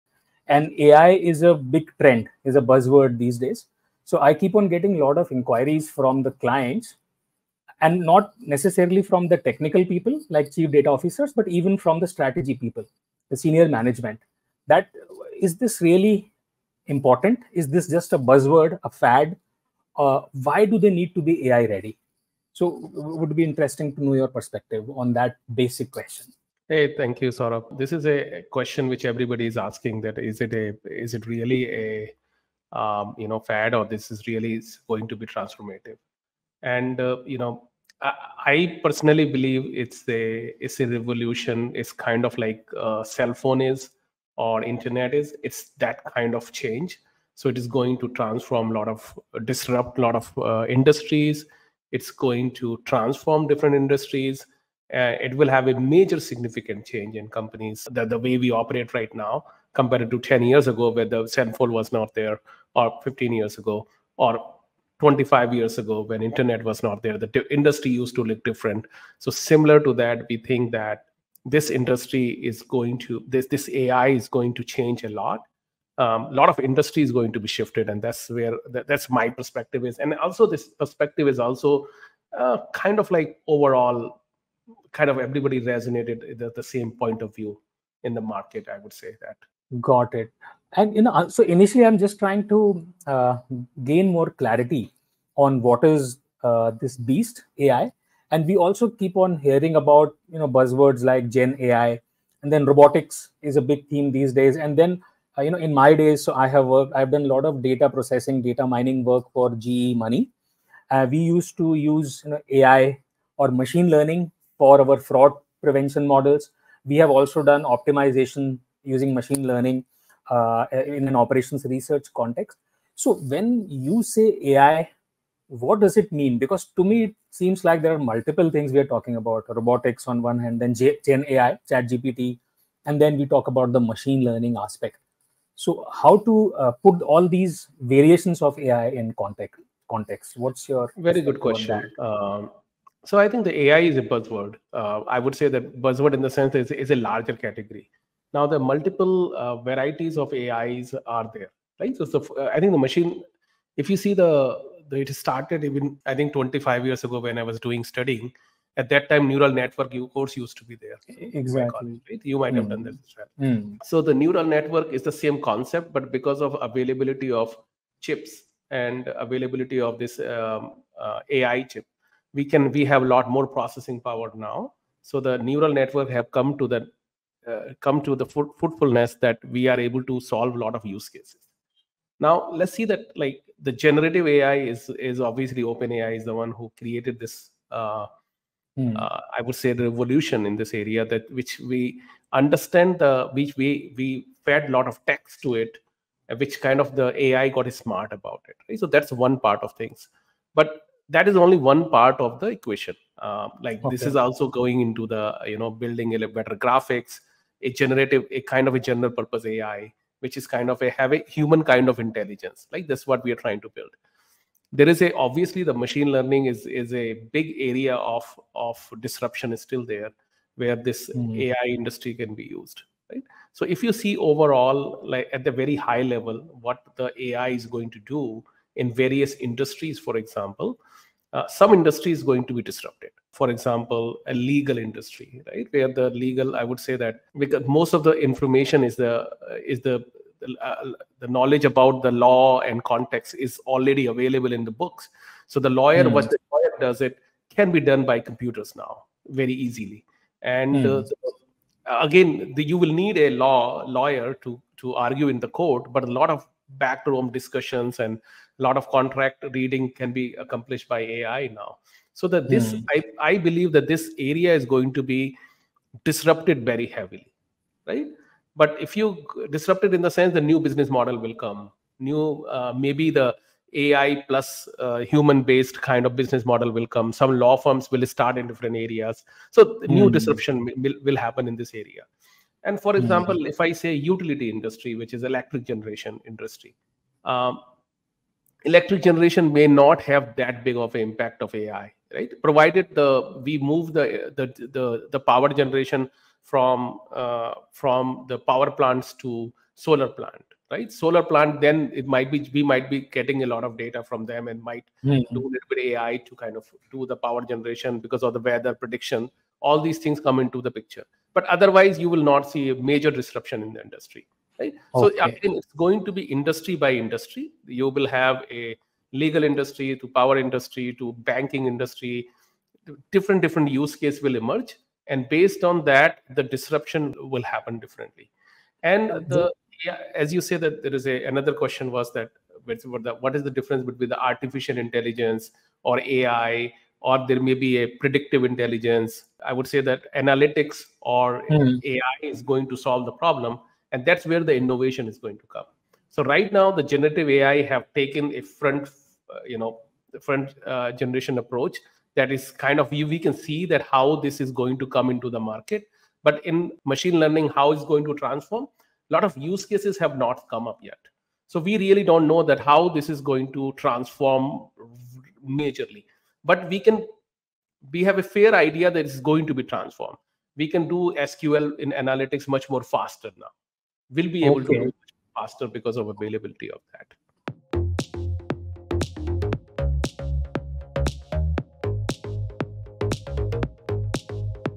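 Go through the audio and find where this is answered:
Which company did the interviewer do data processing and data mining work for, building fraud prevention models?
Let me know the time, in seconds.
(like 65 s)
109 s.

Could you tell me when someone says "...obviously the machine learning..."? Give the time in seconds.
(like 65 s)
215 s.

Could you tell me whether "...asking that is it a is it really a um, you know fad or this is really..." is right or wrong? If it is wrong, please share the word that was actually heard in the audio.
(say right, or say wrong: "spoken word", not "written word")
right.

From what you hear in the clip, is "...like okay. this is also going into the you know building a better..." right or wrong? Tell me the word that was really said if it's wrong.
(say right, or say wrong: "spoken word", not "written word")
right.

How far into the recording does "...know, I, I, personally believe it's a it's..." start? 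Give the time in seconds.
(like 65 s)
37 s.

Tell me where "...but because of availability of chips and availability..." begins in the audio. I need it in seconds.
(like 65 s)
165 s.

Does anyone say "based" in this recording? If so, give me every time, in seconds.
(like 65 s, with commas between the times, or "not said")
275 s, 325 s.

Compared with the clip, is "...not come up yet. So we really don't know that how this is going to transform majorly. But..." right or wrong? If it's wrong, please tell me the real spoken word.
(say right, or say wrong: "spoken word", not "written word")
right.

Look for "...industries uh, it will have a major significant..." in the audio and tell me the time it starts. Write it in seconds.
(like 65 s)
53 s.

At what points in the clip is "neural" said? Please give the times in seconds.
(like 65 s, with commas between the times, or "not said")
159 s, 164 s, 175 s.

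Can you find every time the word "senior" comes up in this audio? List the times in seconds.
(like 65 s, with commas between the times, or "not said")
13 s.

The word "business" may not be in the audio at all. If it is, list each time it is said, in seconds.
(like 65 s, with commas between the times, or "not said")
270 s, 276 s.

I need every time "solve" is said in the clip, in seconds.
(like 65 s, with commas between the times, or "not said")
180 s, 342 s.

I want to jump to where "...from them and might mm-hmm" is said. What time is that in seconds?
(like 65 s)
304 s.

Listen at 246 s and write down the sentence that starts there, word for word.
what the lawyer does it can be done by computers now very easily and mm.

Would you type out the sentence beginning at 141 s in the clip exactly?
Um, so I think the AI is a buzzword.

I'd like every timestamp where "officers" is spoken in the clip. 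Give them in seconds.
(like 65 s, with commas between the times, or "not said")
10 s.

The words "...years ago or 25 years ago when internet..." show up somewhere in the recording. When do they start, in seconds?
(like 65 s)
63 s.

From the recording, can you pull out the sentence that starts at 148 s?
Now the multiple uh, varieties of AIs are there, right?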